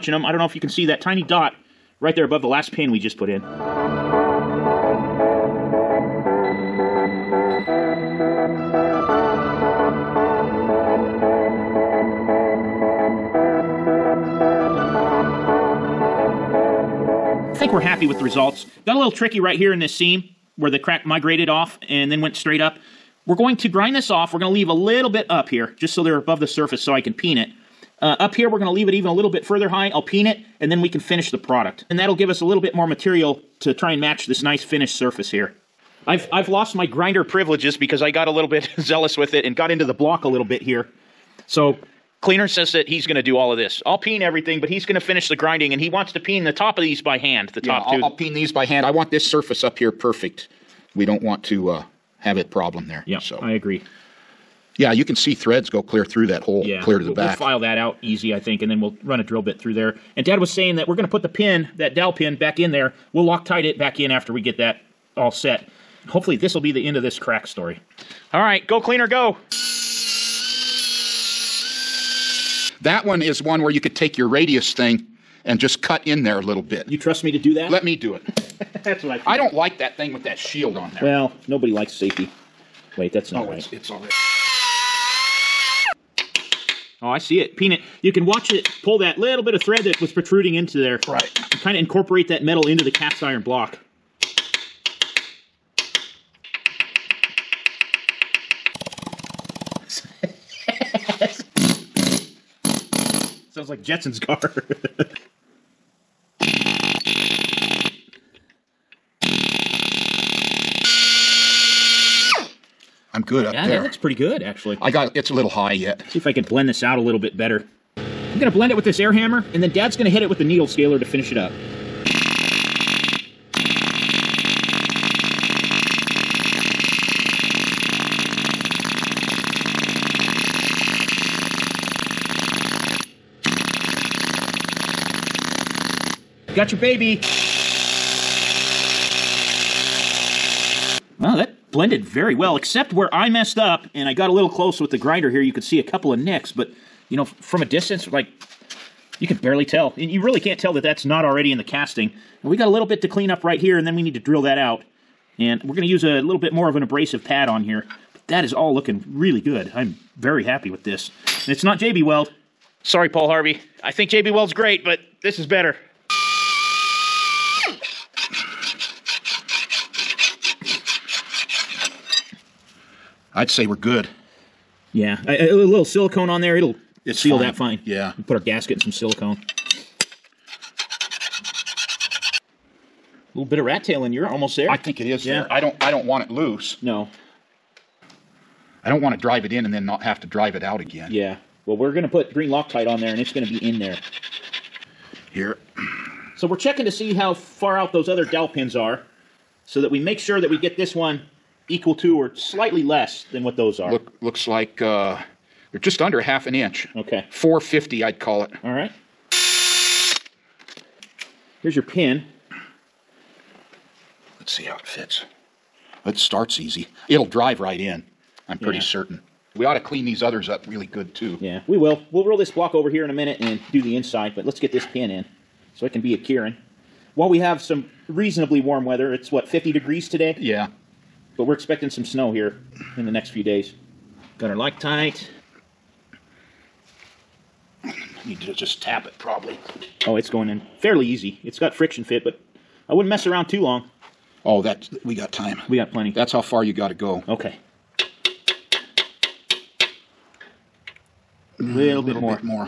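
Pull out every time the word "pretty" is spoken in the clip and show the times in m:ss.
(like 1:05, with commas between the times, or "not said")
1:53, 3:38.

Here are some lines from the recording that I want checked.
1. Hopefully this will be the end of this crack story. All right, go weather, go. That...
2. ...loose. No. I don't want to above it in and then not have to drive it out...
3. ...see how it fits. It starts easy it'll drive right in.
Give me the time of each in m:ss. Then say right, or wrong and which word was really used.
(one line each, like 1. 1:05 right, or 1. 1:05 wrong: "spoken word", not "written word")
1. 1:06 wrong: "cleaner", not "weather"
2. 3:06 wrong: "drive", not "above"
3. 3:34 right.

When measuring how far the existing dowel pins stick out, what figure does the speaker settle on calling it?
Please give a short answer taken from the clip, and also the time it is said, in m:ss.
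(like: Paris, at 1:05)
450, at 3:27.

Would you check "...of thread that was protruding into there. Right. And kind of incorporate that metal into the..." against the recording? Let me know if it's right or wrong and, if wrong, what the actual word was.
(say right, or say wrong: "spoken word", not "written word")
right.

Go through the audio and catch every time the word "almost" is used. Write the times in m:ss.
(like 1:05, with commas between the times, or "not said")
3:04.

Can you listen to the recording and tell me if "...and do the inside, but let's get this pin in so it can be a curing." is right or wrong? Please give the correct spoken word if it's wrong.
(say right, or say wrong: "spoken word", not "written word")
right.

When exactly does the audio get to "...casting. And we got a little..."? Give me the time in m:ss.
2:31.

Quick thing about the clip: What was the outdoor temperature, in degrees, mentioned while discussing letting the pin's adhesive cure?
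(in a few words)
50.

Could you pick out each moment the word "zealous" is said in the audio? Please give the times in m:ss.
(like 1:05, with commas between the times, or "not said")
0:38.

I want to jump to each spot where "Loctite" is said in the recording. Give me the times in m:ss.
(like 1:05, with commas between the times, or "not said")
1:03, 3:12, 3:54.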